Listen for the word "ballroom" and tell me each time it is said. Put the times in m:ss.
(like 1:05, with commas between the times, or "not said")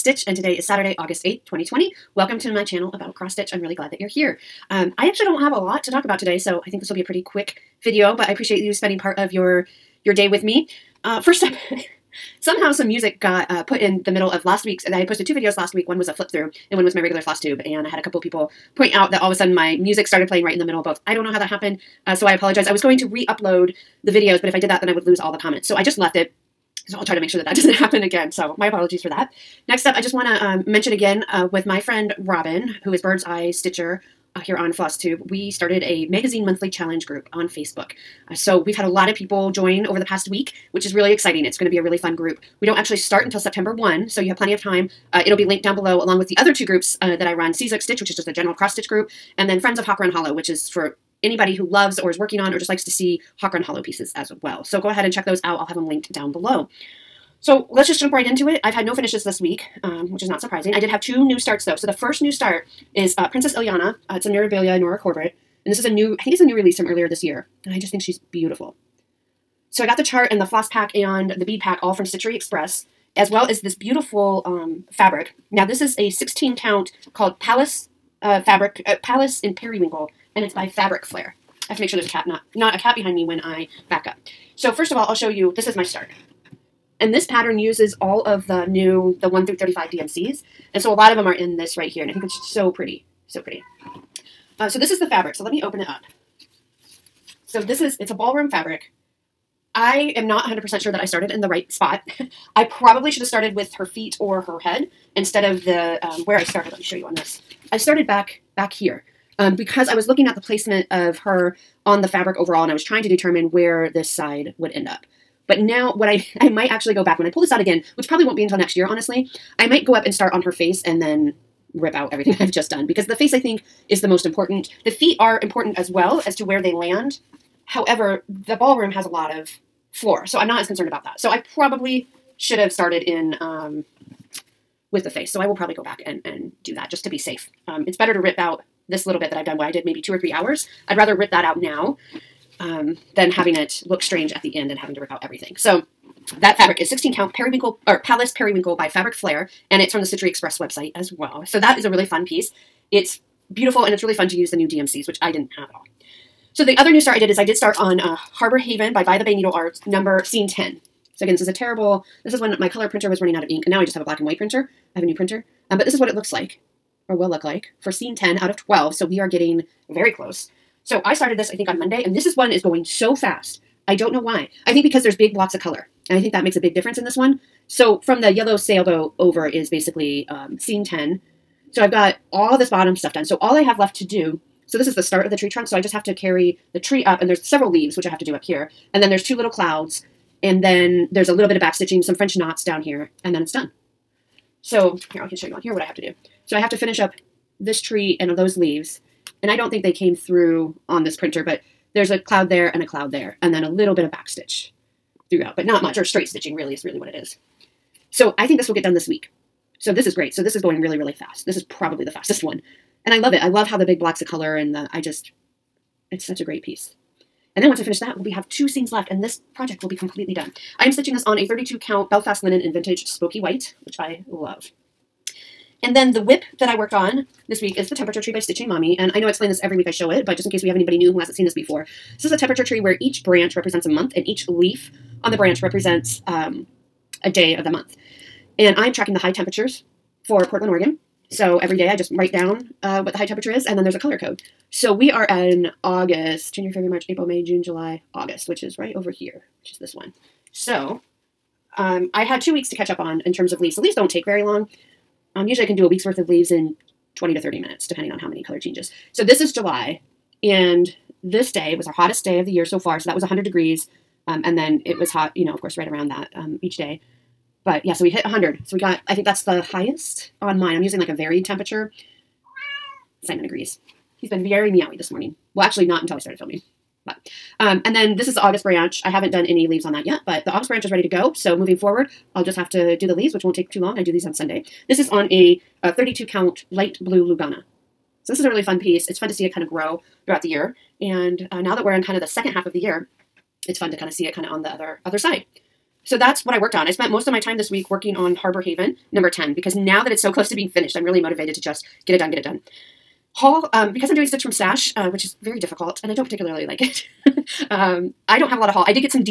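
1:38, 2:08.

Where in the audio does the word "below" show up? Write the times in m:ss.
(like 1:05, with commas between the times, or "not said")
0:45, 0:56.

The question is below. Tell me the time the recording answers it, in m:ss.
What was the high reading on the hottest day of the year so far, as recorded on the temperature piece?
4:23.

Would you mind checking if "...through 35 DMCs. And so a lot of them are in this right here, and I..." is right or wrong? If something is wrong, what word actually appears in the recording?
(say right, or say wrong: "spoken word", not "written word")
right.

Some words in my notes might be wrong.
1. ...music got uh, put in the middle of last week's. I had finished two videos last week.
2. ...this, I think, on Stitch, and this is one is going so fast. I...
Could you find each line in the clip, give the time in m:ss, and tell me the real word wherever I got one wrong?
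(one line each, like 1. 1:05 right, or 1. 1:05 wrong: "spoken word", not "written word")
1. 0:12 wrong: "posted", not "finished"
2. 2:51 wrong: "Monday", not "Stitch".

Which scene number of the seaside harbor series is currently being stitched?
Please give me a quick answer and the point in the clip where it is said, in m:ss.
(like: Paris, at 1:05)
10, at 2:39.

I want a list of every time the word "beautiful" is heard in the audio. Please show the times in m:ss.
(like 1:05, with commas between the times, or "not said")
1:08, 1:13, 2:33.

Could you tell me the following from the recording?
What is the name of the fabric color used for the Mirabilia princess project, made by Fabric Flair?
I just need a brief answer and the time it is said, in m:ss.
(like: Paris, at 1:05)
Palace Periwinkle, at 1:19.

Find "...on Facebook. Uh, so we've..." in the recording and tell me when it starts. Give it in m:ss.
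0:37.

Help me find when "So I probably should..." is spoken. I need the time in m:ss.
2:11.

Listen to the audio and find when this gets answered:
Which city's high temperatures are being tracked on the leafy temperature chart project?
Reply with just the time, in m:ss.
4:00.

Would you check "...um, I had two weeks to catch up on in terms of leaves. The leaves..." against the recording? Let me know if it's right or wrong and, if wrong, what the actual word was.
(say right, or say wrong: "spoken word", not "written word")
right.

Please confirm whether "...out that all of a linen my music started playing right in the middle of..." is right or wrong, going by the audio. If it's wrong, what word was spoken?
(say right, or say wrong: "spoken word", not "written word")
wrong: "sudden", not "linen".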